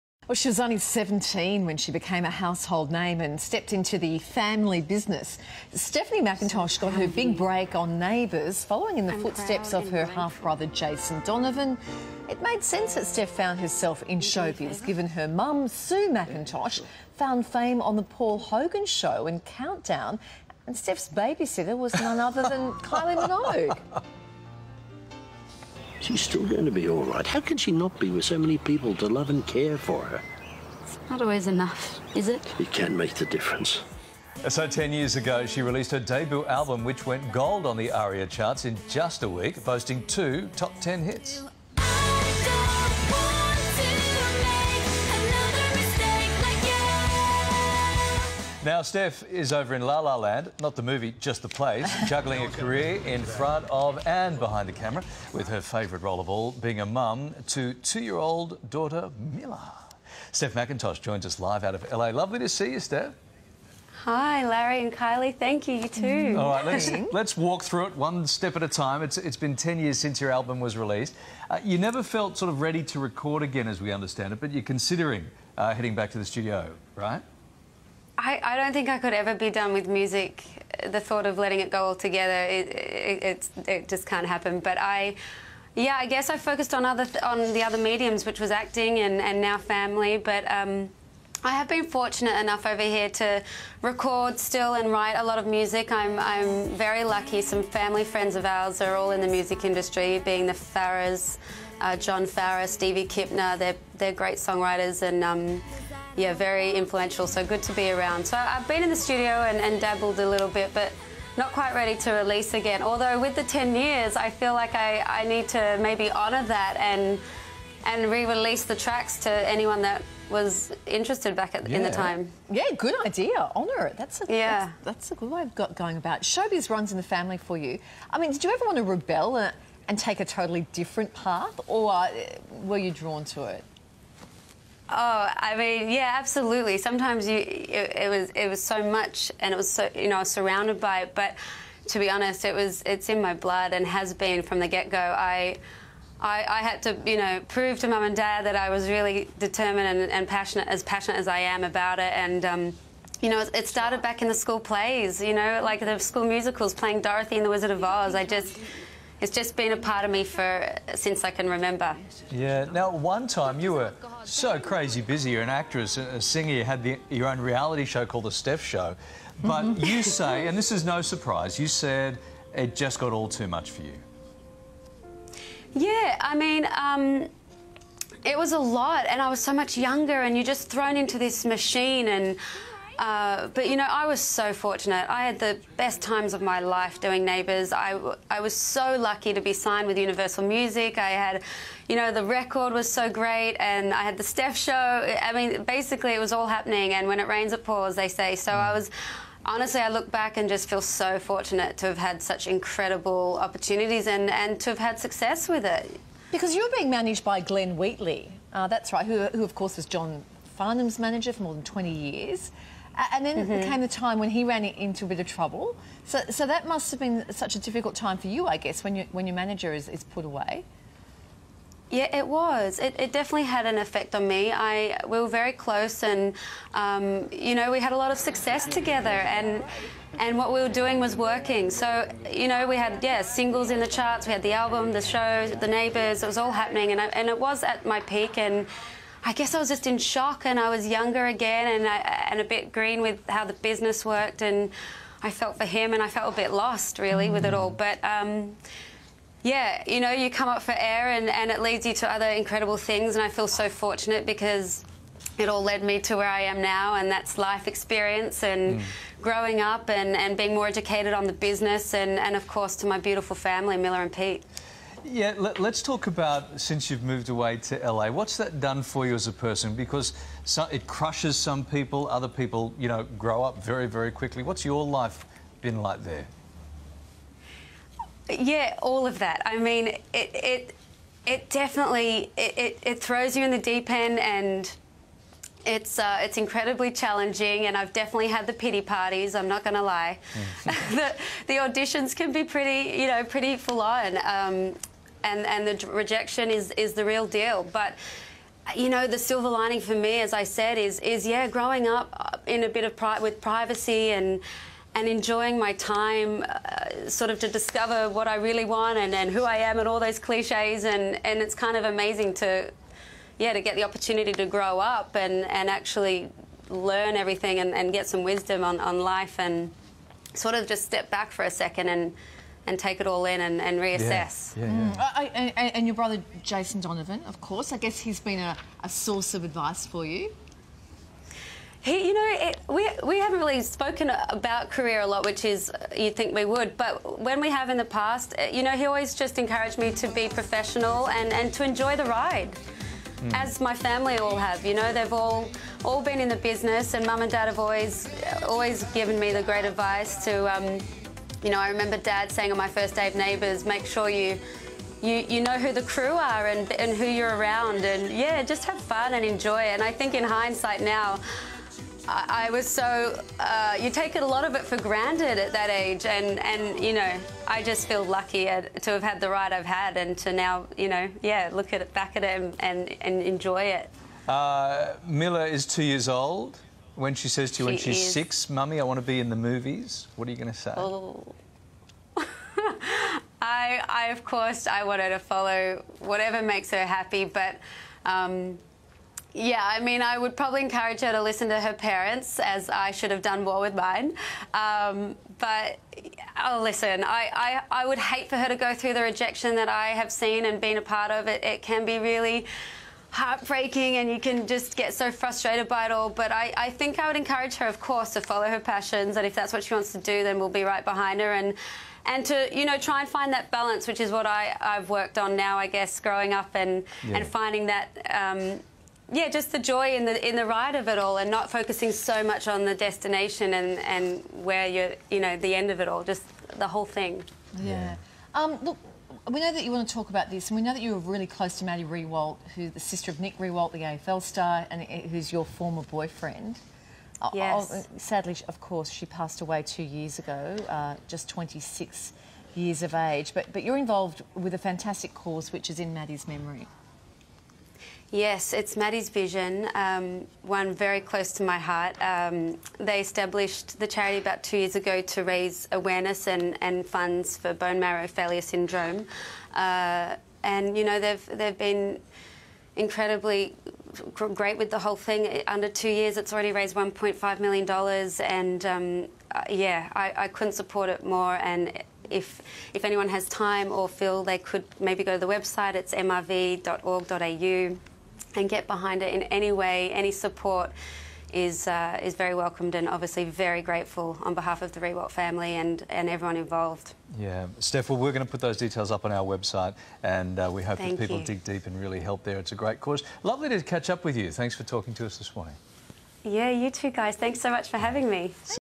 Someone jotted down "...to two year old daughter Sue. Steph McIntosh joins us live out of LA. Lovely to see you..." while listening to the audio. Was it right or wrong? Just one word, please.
wrong.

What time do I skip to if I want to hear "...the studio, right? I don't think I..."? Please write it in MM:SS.
01:16.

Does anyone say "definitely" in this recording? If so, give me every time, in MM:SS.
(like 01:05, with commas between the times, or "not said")
03:43, 04:41, 04:47.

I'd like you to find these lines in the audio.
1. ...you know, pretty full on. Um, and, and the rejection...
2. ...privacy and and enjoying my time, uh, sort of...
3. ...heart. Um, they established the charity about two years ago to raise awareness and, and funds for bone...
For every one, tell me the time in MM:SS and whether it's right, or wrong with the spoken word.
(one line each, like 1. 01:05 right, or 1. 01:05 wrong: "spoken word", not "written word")
1. 04:53 right
2. 05:03 right
3. 07:31 right.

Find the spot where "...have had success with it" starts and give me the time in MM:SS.
03:24.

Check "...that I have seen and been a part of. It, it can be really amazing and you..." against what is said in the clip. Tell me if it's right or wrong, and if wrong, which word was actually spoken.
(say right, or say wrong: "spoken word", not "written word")
wrong: "heartbreaking", not "amazing".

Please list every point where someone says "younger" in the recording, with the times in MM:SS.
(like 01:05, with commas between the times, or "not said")
02:59, 04:00.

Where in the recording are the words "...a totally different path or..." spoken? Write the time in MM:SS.
02:10.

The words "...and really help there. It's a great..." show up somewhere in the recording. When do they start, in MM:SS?
08:11.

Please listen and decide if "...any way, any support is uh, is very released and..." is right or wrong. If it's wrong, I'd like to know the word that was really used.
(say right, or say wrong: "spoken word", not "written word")
wrong: "welcomed", not "released".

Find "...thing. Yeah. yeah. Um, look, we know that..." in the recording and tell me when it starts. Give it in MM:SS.
07:06.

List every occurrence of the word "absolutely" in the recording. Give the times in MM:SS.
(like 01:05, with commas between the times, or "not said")
02:16.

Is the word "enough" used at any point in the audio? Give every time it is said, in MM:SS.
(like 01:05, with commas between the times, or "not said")
00:31, 01:32.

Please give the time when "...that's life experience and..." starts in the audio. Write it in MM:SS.
04:17.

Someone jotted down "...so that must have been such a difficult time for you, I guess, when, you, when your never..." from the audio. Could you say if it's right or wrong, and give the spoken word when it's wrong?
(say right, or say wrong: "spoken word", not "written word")
wrong: "manager", not "never".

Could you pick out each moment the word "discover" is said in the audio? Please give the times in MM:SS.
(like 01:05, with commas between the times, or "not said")
05:07.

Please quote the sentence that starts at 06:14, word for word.
Uh, Miller is two years old.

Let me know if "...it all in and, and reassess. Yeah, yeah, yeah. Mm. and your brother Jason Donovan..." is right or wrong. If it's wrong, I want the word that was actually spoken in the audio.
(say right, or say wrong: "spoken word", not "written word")
right.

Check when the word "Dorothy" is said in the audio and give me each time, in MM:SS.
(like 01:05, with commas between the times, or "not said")
02:37.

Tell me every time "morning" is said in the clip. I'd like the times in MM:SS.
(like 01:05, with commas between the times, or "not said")
08:15.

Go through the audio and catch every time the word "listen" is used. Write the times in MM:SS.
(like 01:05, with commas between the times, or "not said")
06:31, 06:36.